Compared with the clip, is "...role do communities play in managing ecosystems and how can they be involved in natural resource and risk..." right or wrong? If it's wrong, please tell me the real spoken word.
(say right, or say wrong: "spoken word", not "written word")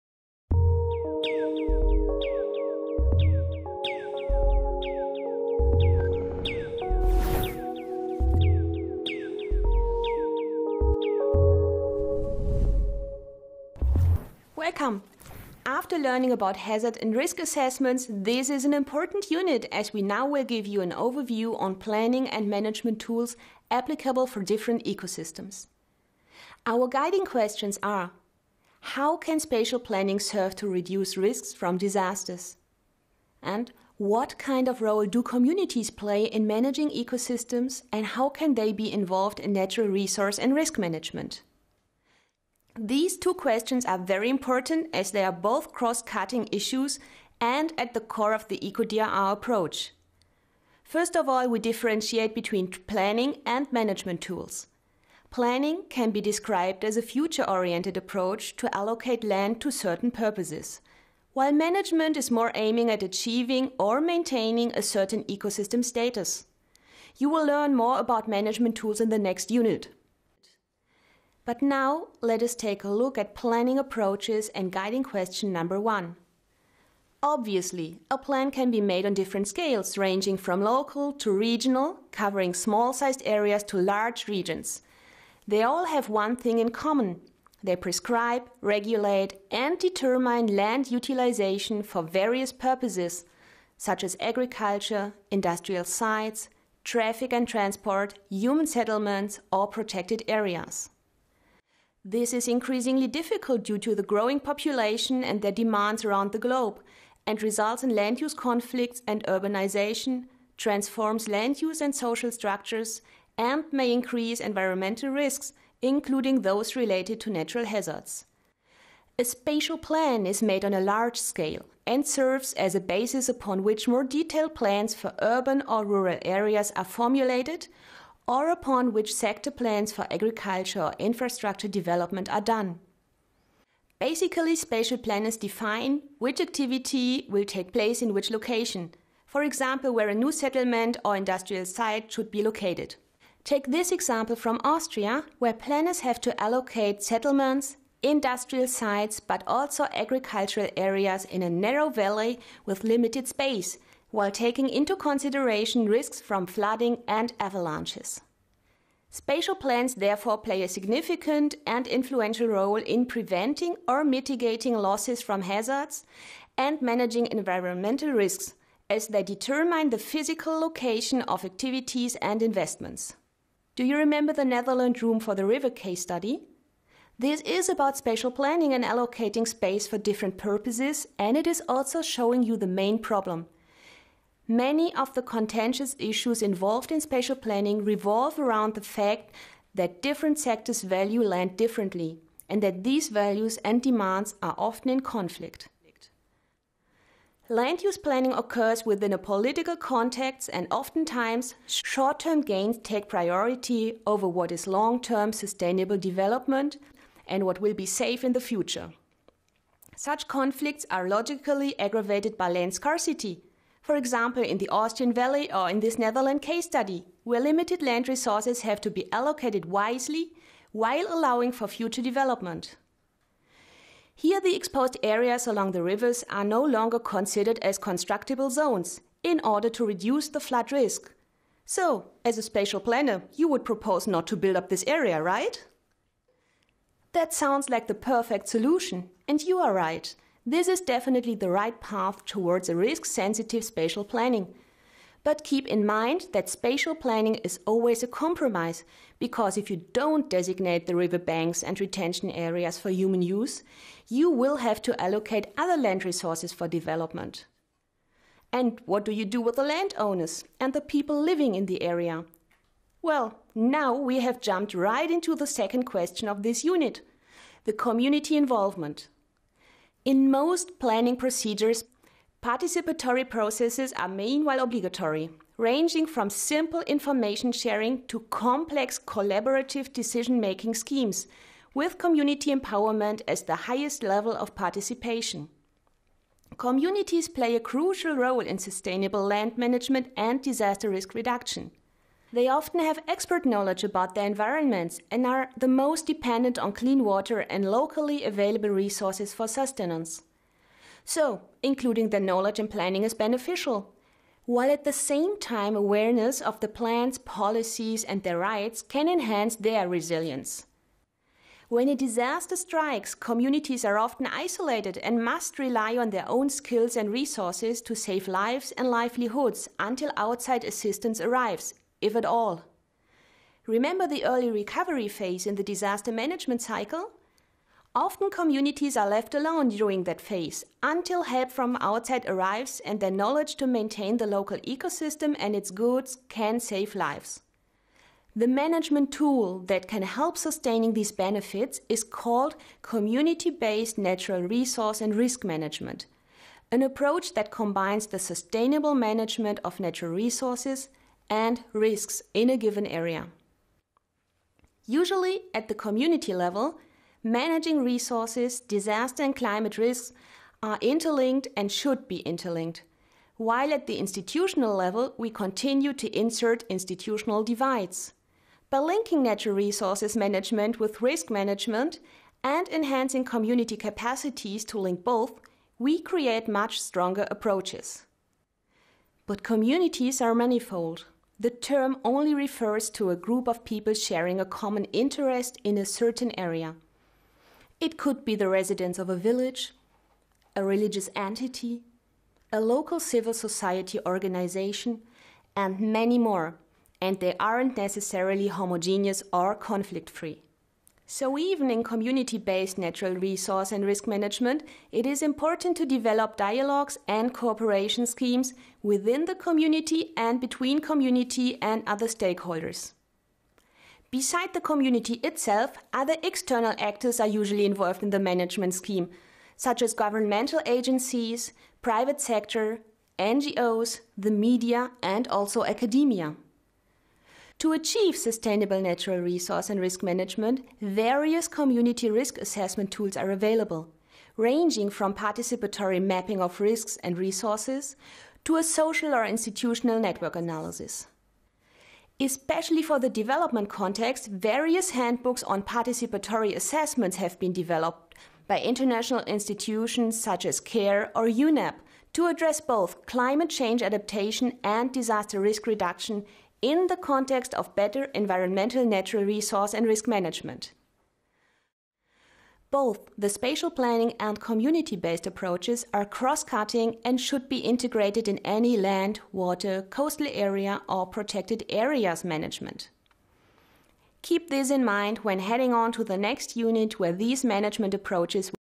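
right.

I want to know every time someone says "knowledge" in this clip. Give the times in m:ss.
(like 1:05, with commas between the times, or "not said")
4:53, 5:02, 5:33.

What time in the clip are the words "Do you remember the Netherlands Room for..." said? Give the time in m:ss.
2:53.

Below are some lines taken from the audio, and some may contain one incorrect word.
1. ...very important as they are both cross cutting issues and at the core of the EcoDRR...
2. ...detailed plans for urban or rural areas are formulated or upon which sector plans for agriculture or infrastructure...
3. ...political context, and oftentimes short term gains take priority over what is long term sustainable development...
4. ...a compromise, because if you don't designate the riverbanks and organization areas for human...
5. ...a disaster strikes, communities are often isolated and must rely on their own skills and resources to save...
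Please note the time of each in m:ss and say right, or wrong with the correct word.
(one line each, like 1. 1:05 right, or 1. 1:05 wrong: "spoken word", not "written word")
1. 0:43 right
2. 2:04 right
3. 3:19 right
4. 4:08 wrong: "retention", not "organization"
5. 5:11 right.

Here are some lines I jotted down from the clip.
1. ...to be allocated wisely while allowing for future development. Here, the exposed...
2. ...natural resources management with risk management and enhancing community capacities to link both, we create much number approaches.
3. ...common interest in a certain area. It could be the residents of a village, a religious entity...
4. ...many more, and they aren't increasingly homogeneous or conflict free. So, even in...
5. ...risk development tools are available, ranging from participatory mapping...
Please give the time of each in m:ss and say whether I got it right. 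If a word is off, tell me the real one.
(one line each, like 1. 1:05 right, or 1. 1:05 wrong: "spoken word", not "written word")
1. 3:38 right
2. 6:09 wrong: "stronger", not "number"
3. 6:24 right
4. 6:35 wrong: "necessarily", not "increasingly"
5. 7:12 wrong: "assessment", not "development".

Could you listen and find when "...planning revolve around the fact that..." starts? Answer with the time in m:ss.
3:07.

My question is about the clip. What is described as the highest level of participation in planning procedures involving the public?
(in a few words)
Community empowerment.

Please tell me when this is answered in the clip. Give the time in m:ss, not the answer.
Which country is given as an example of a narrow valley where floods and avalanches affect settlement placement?
2:24.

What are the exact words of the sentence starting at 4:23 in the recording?
Well, now we have jumped right into the second question of this unit the community involvement.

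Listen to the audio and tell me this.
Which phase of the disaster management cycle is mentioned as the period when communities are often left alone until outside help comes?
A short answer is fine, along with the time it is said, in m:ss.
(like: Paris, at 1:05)
Early recovery phase, at 5:24.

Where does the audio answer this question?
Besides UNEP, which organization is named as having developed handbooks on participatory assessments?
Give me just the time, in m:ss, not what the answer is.
7:30.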